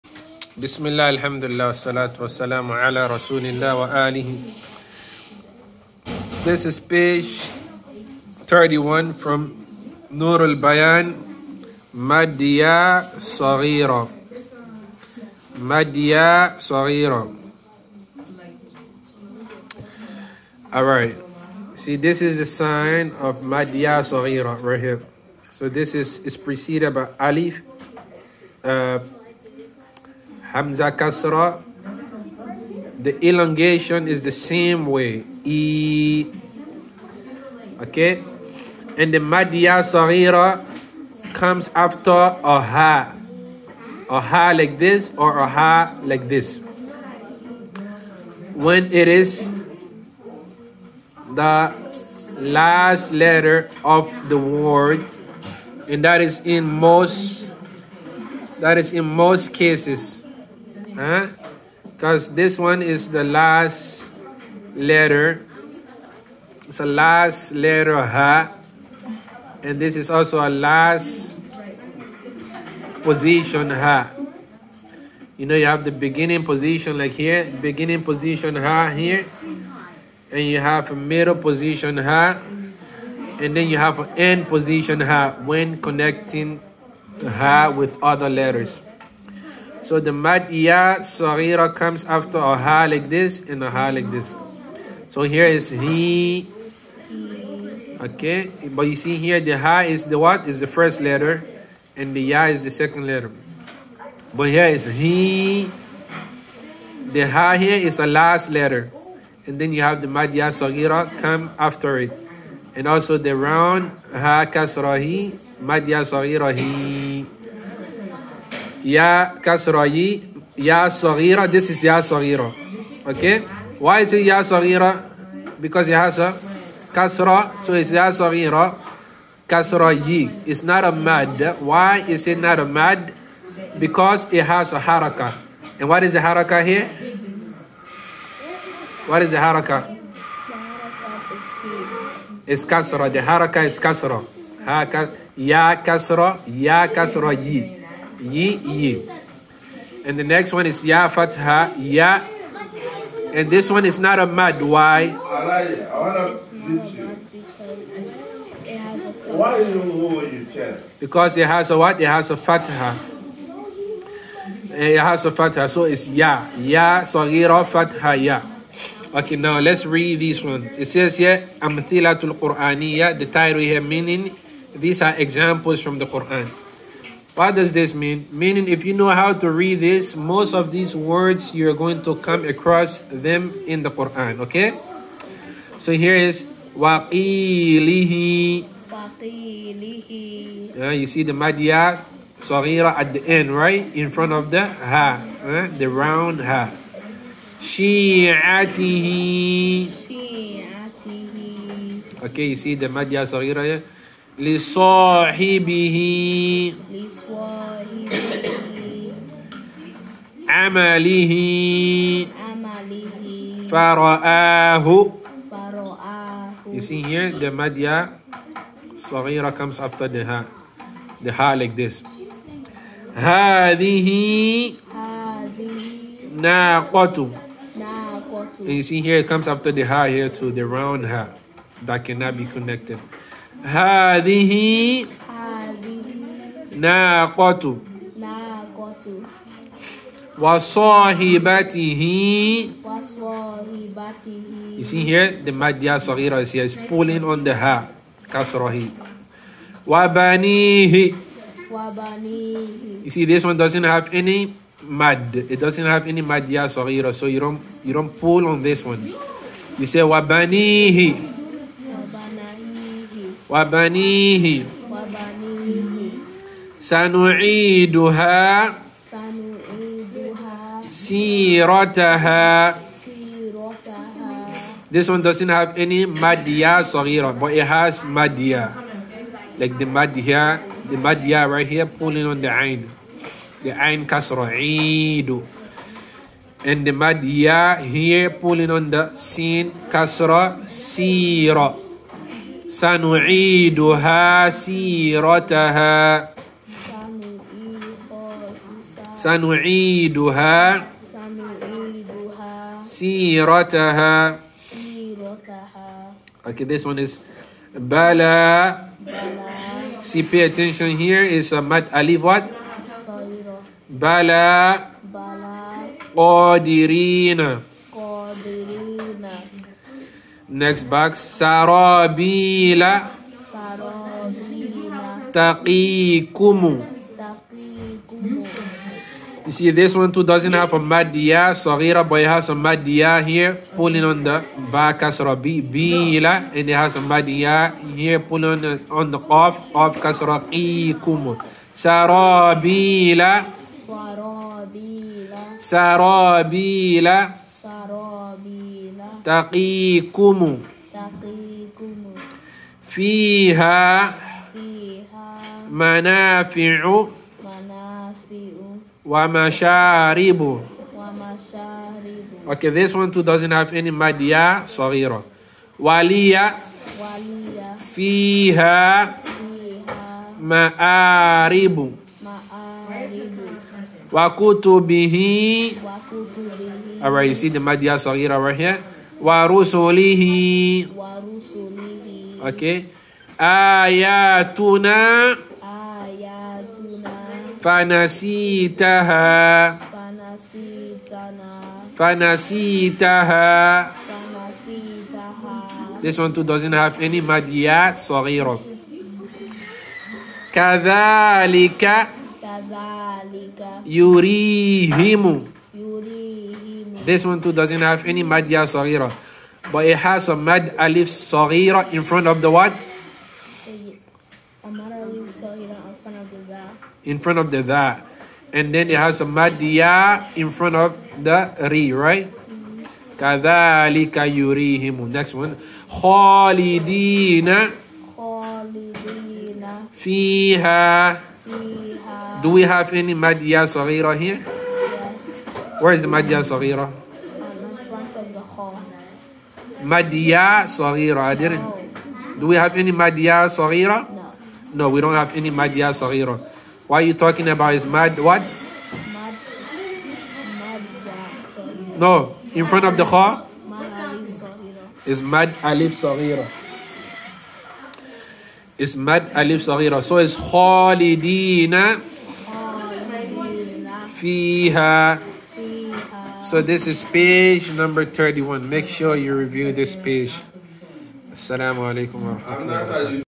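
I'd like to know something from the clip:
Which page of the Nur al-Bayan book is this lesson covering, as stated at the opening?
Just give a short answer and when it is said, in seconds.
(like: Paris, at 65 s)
31, at 6 s.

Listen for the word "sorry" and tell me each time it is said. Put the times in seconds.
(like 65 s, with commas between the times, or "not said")
397 s.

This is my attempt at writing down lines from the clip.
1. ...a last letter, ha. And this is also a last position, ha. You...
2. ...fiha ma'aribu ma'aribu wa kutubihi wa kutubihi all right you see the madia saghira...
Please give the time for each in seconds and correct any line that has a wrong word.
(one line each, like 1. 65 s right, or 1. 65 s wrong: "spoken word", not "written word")
1. 66 s right
2. 367 s right.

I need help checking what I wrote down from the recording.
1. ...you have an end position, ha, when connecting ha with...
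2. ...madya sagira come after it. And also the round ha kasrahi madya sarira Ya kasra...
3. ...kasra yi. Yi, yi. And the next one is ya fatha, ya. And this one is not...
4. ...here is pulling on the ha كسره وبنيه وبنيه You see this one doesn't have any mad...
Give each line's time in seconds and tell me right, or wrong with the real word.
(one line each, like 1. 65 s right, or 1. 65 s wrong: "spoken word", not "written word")
1. 83 s right
2. 110 s wrong: "sagira", not "sarira"
3. 146 s right
4. 246 s right.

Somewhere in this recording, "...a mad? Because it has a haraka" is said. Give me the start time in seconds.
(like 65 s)
132 s.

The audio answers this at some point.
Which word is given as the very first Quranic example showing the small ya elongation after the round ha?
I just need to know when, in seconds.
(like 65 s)
185 s.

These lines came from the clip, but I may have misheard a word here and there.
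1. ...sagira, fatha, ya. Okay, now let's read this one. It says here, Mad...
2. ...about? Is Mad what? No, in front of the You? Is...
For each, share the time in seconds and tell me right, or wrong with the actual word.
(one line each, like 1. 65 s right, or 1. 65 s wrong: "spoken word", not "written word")
1. 167 s wrong: "Amthilatul", not "Mad"
2. 447 s wrong: "Kha", not "You".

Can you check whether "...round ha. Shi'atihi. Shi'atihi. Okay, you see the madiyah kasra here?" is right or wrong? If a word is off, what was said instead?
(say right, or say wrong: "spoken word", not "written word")
wrong: "saghira", not "kasra".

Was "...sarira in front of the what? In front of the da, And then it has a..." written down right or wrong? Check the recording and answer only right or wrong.
wrong.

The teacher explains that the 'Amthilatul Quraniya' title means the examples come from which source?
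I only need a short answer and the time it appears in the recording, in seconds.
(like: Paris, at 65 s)
The Qur'an, at 174 s.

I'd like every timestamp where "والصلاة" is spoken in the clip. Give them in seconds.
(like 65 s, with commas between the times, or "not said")
1 s.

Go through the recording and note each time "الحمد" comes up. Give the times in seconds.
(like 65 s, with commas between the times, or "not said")
1 s.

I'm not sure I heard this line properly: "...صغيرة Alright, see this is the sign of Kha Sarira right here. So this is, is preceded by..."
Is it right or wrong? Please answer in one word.
wrong.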